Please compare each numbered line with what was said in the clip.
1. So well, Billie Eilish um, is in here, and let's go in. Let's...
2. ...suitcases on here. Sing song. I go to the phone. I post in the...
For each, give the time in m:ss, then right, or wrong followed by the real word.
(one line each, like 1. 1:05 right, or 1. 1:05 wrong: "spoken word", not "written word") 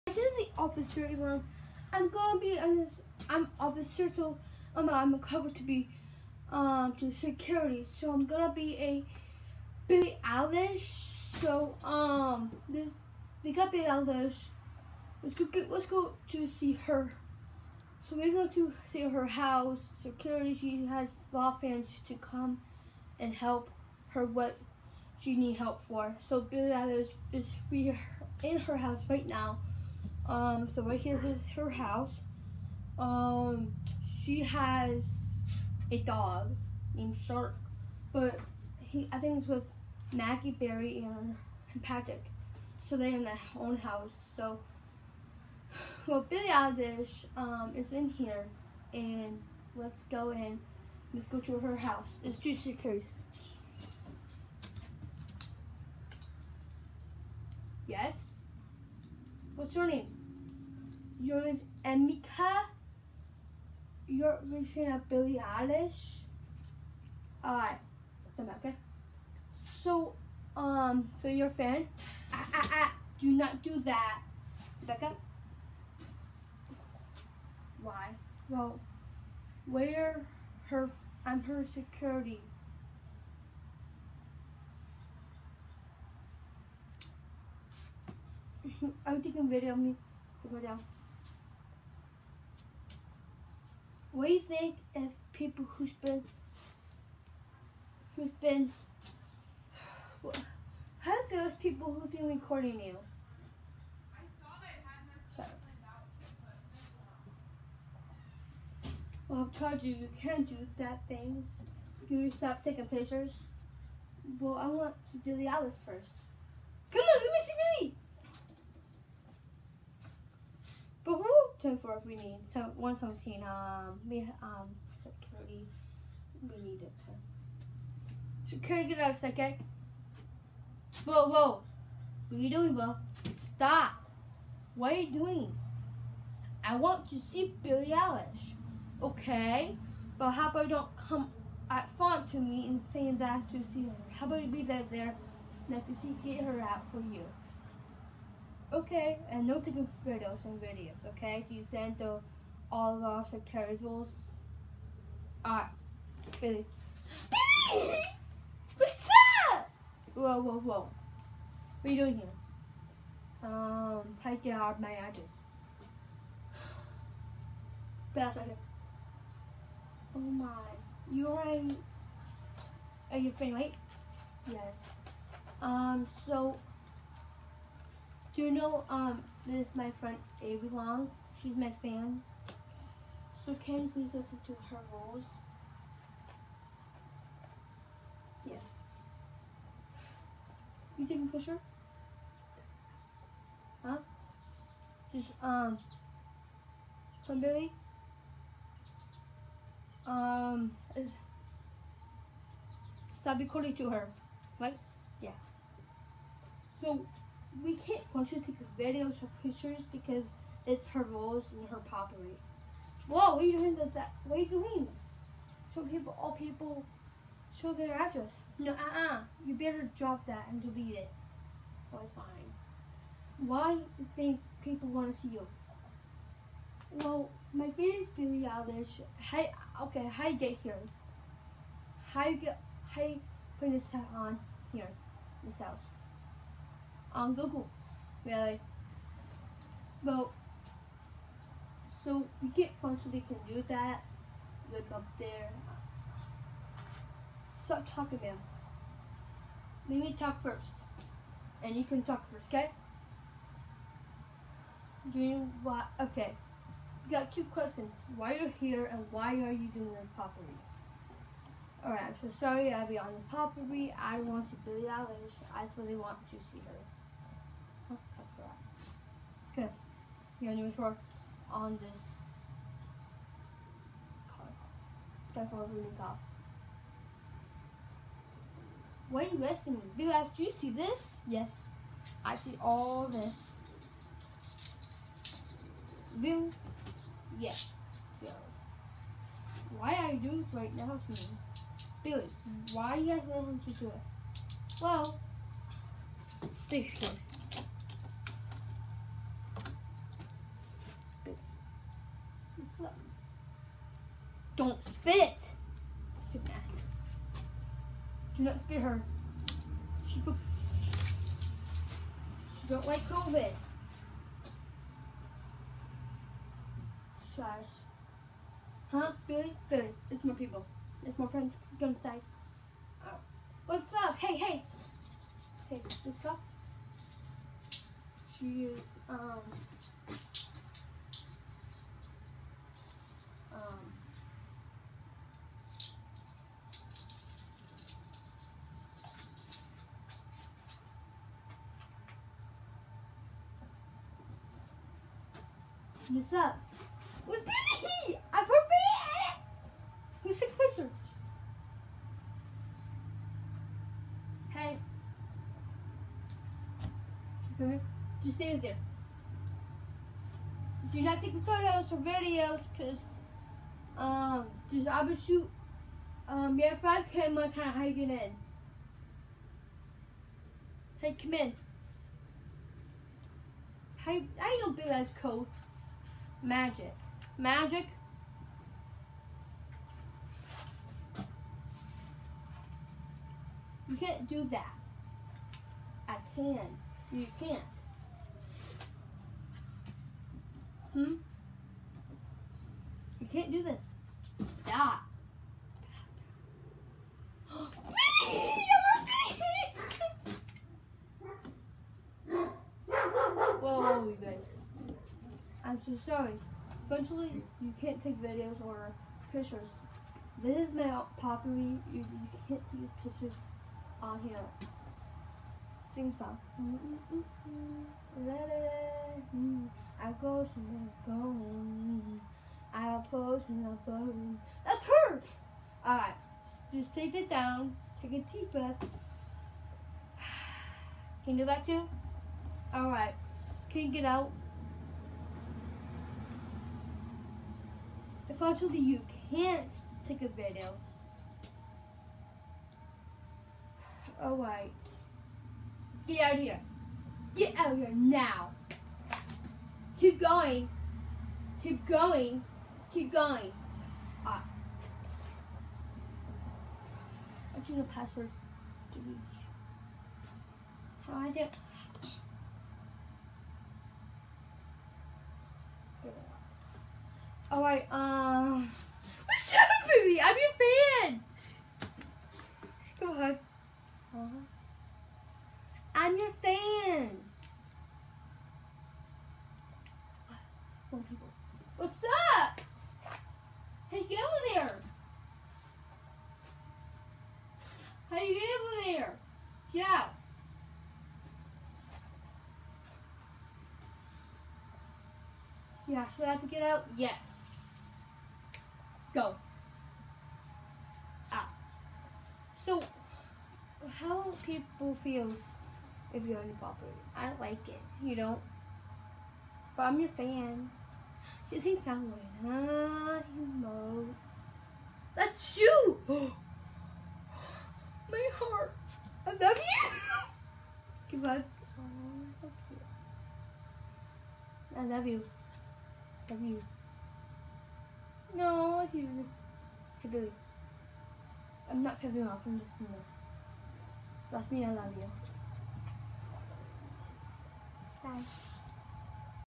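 1. 0:44 right
2. 6:53 wrong: "pictures", not "suitcases".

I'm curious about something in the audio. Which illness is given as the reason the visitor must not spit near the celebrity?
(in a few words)
COVID.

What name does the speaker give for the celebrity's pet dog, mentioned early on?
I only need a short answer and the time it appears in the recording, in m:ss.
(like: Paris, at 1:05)
Shark, at 0:37.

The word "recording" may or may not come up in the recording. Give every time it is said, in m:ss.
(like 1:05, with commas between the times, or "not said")
1:42, 3:23.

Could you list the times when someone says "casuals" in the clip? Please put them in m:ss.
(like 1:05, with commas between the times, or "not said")
2:33.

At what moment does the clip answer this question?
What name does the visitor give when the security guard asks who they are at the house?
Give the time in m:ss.
1:01.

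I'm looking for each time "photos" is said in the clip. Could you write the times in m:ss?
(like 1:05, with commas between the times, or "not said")
2:30, 6:01.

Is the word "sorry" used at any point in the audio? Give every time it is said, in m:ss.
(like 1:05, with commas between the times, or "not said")
1:45, 4:22, 6:46.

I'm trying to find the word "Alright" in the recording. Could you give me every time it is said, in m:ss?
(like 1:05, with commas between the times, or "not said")
1:07, 4:21, 7:05, 7:12, 7:24, 7:47.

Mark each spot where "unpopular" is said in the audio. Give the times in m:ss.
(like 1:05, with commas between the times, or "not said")
8:26.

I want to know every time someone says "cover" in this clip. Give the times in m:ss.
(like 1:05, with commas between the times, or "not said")
0:05.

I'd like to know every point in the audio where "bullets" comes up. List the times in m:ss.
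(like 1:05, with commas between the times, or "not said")
not said.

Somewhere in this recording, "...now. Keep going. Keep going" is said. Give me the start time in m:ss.
7:27.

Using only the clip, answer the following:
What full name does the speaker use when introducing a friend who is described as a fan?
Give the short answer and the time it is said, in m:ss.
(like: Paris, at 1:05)
Avery Long, at 3:00.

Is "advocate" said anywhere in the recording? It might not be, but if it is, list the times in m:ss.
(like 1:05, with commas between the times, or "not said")
not said.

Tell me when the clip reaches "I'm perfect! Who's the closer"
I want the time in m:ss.
5:48.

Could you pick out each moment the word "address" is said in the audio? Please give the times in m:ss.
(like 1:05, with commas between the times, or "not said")
2:44, 3:37.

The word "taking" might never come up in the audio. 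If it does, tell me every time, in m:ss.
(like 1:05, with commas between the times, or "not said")
1:29, 1:52, 2:29, 3:11.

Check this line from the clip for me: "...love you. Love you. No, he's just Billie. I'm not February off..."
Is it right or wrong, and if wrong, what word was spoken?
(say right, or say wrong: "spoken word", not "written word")
wrong: "February", not "Billie".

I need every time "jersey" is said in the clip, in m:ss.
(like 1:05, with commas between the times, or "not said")
not said.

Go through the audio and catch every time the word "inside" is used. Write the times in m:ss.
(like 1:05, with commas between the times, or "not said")
5:21.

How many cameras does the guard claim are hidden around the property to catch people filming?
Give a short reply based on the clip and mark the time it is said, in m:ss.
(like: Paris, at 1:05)
5, at 6:06.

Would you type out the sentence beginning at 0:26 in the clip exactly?
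So Billie Eilish is we in her house right now.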